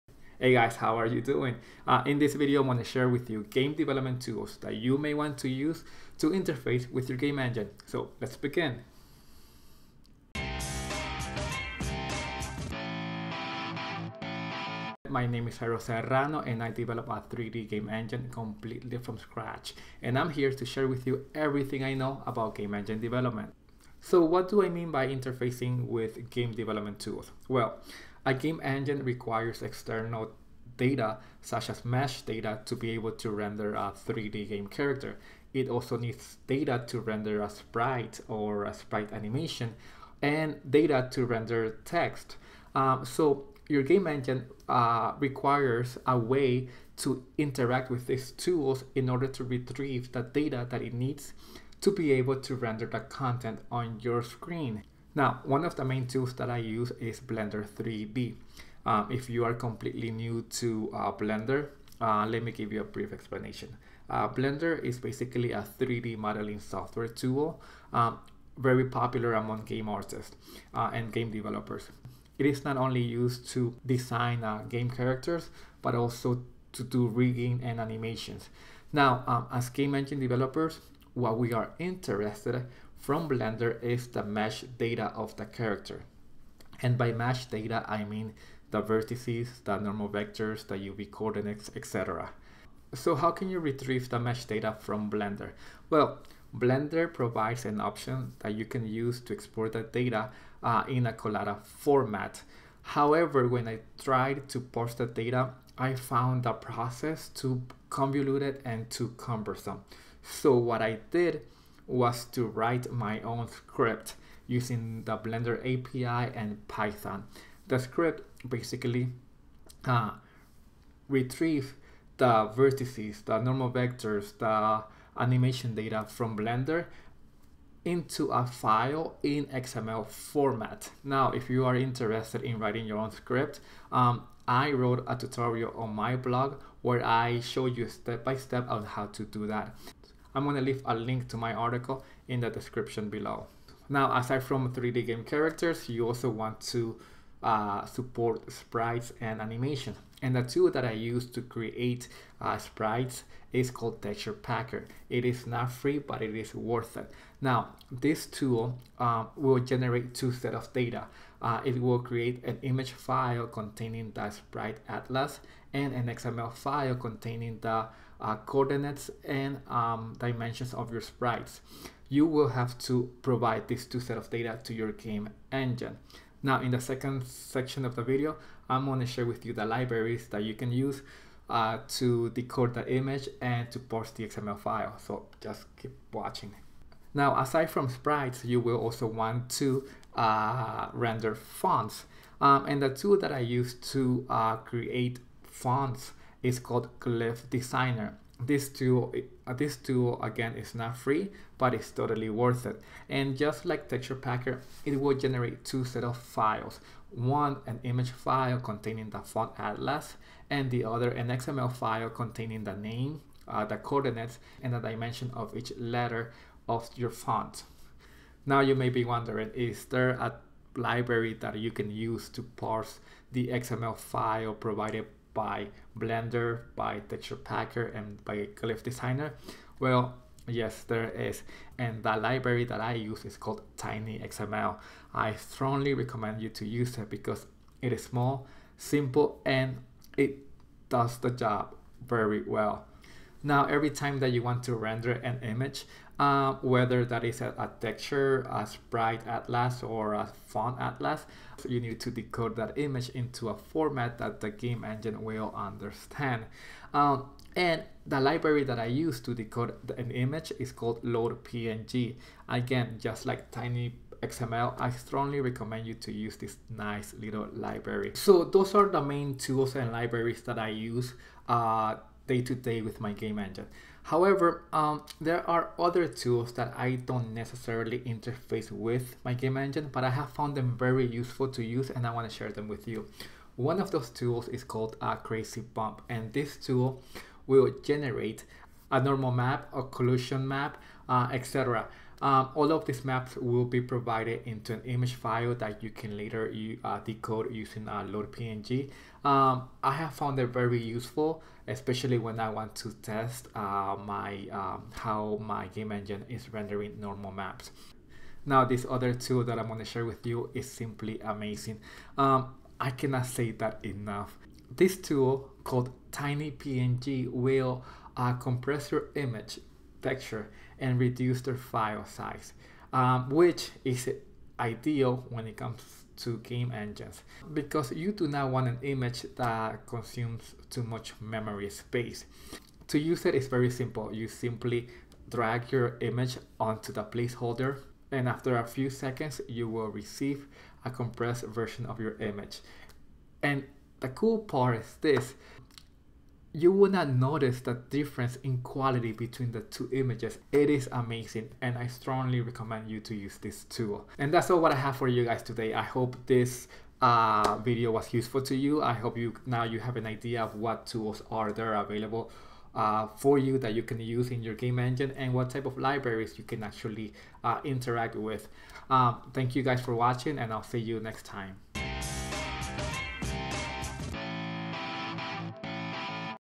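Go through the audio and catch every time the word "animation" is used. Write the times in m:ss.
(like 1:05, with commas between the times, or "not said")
0:39, 1:17, 2:05, 2:29.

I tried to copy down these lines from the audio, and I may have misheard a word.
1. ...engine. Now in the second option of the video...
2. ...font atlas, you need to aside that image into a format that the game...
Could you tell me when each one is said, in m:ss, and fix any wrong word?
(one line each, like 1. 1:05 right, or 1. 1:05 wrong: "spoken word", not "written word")
1. 2:55 wrong: "section", not "option"
2. 4:10 wrong: "decode", not "aside".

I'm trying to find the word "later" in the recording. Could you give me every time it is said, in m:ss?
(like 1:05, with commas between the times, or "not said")
4:56.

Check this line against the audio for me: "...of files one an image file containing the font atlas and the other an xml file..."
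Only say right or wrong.
right.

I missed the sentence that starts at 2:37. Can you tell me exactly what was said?
Now, this tool um, will generate two set of data.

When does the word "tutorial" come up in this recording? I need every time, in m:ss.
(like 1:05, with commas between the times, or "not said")
2:15.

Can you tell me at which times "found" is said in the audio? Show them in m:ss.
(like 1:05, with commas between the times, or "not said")
1:45, 4:40, 5:00.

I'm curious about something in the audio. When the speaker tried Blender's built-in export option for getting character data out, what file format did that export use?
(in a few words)
Collada.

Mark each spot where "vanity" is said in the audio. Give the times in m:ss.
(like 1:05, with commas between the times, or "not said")
not said.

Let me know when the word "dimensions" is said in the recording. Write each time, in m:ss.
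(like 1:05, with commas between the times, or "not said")
2:50, 3:34.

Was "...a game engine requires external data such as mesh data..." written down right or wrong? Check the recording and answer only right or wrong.
right.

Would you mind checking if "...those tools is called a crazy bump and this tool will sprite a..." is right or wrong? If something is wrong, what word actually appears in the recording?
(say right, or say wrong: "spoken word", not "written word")
wrong: "generate", not "sprite".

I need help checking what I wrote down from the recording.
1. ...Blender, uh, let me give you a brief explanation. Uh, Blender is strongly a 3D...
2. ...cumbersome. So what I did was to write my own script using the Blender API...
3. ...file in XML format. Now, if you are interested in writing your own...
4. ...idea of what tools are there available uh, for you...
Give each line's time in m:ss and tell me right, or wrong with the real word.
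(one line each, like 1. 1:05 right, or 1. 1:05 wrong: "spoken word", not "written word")
1. 1:01 wrong: "basically", not "strongly"
2. 1:49 right
3. 2:08 right
4. 6:00 right.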